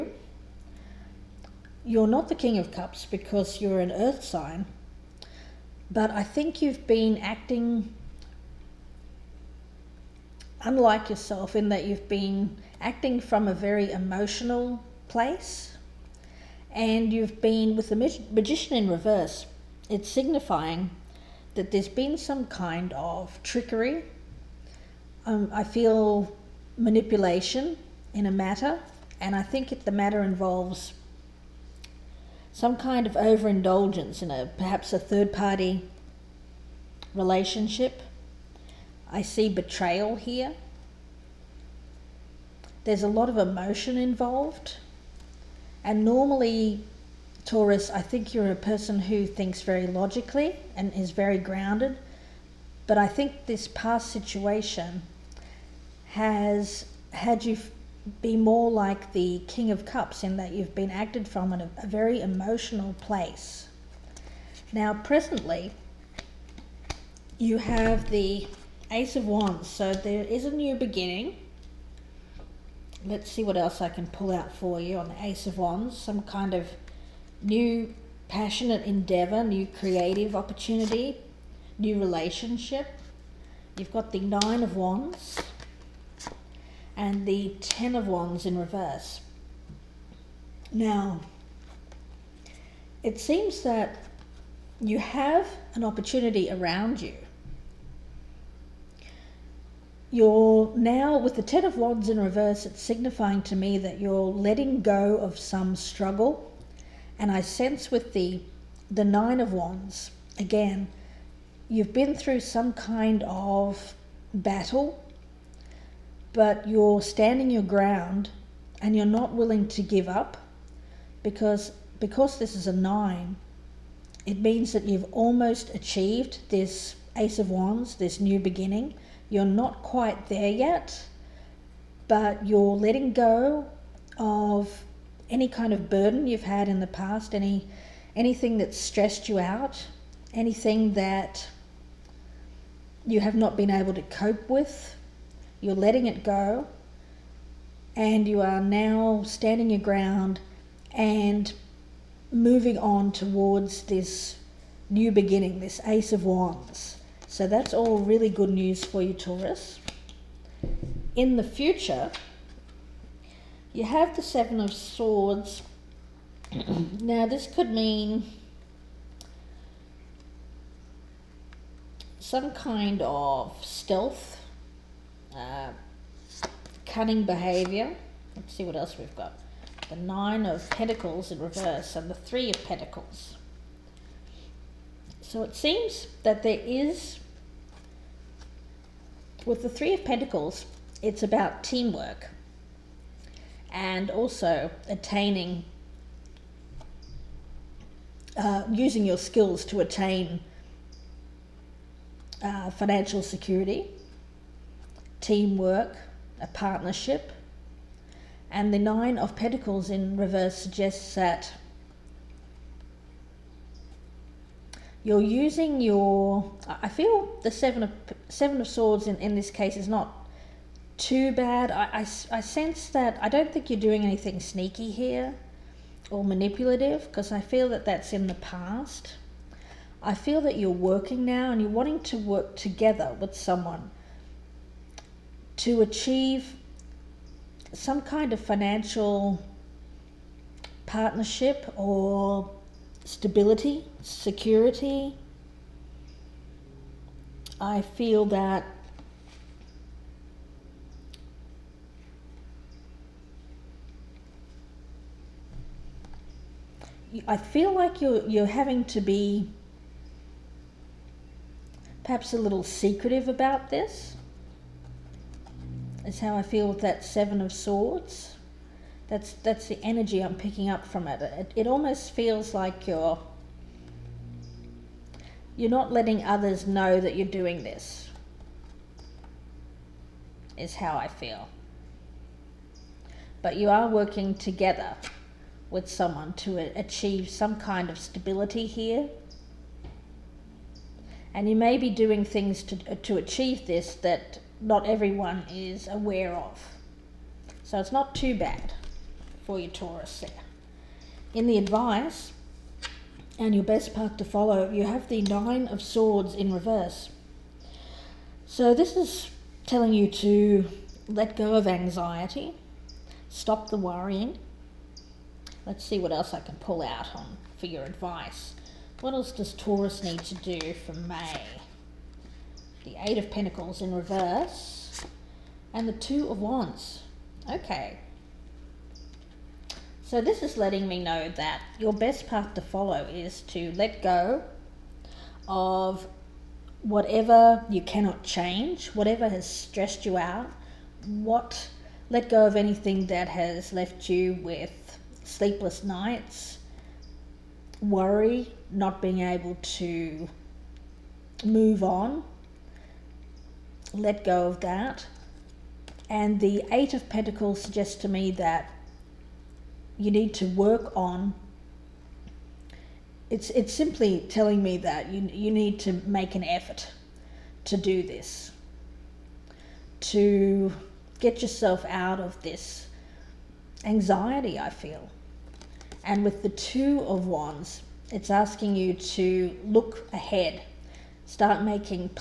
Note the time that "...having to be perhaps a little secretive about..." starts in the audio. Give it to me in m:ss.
4:18.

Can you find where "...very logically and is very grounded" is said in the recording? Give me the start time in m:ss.
0:49.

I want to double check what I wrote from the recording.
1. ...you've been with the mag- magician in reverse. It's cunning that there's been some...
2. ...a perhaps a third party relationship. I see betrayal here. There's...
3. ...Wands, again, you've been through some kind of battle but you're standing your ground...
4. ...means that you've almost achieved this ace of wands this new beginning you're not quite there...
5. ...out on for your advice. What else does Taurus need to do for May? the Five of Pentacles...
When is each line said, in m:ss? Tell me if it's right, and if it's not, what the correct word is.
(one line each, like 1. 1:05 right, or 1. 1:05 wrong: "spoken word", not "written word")
1. 0:17 wrong: "signifying", not "cunning"
2. 0:34 right
3. 1:49 right
4. 2:04 right
5. 5:16 wrong: "Eight", not "Five".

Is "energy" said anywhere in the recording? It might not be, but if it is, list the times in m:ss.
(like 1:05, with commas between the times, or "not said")
4:29.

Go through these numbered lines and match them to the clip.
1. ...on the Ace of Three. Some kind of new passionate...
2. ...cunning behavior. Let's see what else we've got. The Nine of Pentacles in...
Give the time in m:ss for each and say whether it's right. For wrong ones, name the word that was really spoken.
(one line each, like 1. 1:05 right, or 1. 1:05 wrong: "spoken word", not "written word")
1. 1:14 wrong: "Wands", not "Three"
2. 2:56 right.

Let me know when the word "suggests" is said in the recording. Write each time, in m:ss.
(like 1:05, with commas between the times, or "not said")
3:30, 5:57.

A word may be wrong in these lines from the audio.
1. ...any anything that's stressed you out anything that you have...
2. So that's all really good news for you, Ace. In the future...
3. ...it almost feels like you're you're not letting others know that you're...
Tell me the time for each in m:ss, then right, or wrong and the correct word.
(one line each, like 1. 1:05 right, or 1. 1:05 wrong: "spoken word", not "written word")
1. 2:17 right
2. 2:37 wrong: "Taurus", not "Ace"
3. 4:31 right.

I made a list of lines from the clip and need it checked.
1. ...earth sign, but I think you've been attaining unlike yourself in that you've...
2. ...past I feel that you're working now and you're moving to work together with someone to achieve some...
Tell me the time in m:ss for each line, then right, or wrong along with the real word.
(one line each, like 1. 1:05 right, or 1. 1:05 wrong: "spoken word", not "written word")
1. 0:03 wrong: "acting", not "attaining"
2. 3:48 wrong: "wanting", not "moving".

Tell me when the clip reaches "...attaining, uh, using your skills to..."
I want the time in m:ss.
3:14.